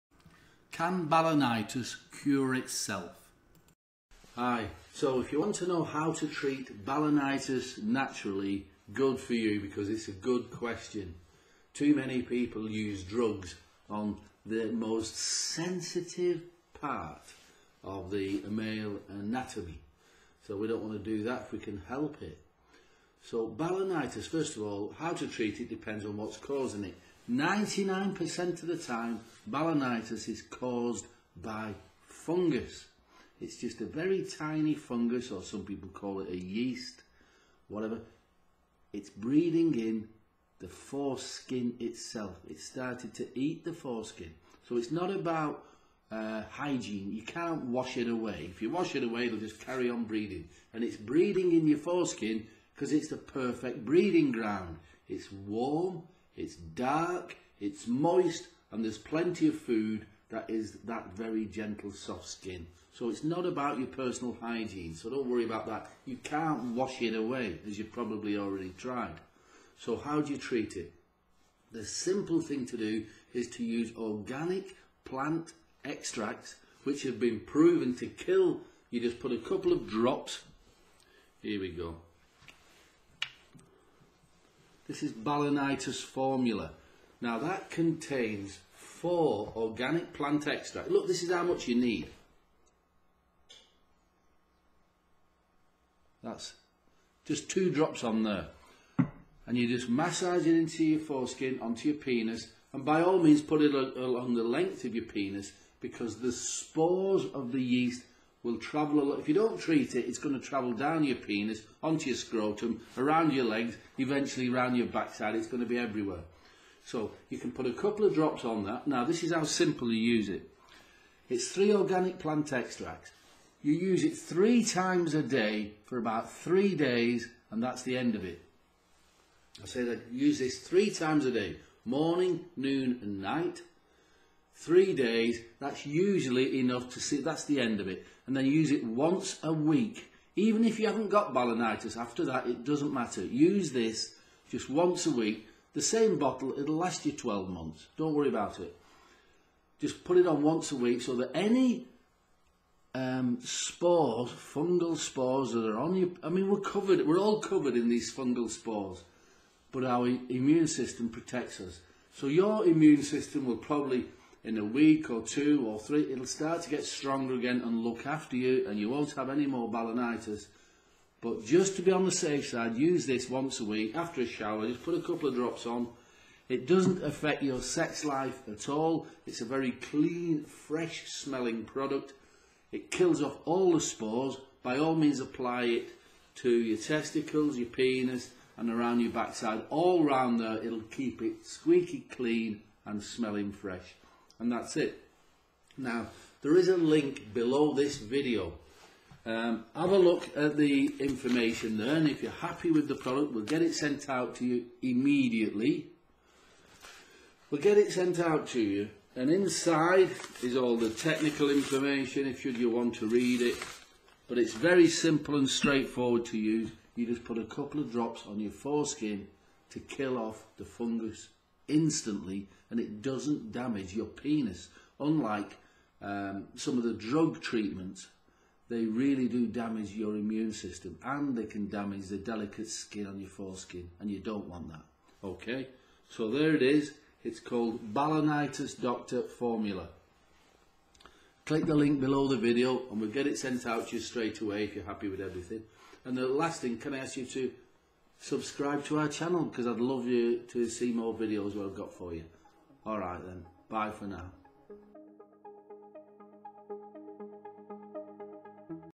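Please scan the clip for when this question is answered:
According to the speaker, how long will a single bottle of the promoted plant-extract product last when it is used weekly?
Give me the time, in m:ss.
2:27.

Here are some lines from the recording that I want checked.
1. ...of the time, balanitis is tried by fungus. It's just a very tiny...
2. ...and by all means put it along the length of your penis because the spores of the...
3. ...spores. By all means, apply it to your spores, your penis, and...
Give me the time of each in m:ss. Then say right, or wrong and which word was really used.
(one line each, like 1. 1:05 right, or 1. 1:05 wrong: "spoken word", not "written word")
1. 0:28 wrong: "caused", not "tried"
2. 1:42 right
3. 3:03 wrong: "testicles", not "spores".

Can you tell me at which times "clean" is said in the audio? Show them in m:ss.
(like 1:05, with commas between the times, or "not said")
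2:59, 3:12.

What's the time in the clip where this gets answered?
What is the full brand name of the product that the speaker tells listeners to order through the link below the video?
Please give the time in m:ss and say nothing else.
3:57.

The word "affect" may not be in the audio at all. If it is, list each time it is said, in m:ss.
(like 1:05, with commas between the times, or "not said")
2:57.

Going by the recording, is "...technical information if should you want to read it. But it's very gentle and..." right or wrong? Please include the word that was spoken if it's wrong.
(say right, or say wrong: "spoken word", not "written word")
wrong: "simple", not "gentle".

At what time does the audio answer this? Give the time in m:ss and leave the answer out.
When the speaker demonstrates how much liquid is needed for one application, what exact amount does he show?
1:37.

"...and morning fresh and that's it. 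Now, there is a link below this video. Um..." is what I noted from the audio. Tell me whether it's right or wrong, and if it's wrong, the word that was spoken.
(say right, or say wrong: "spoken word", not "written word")
wrong: "smelling", not "morning".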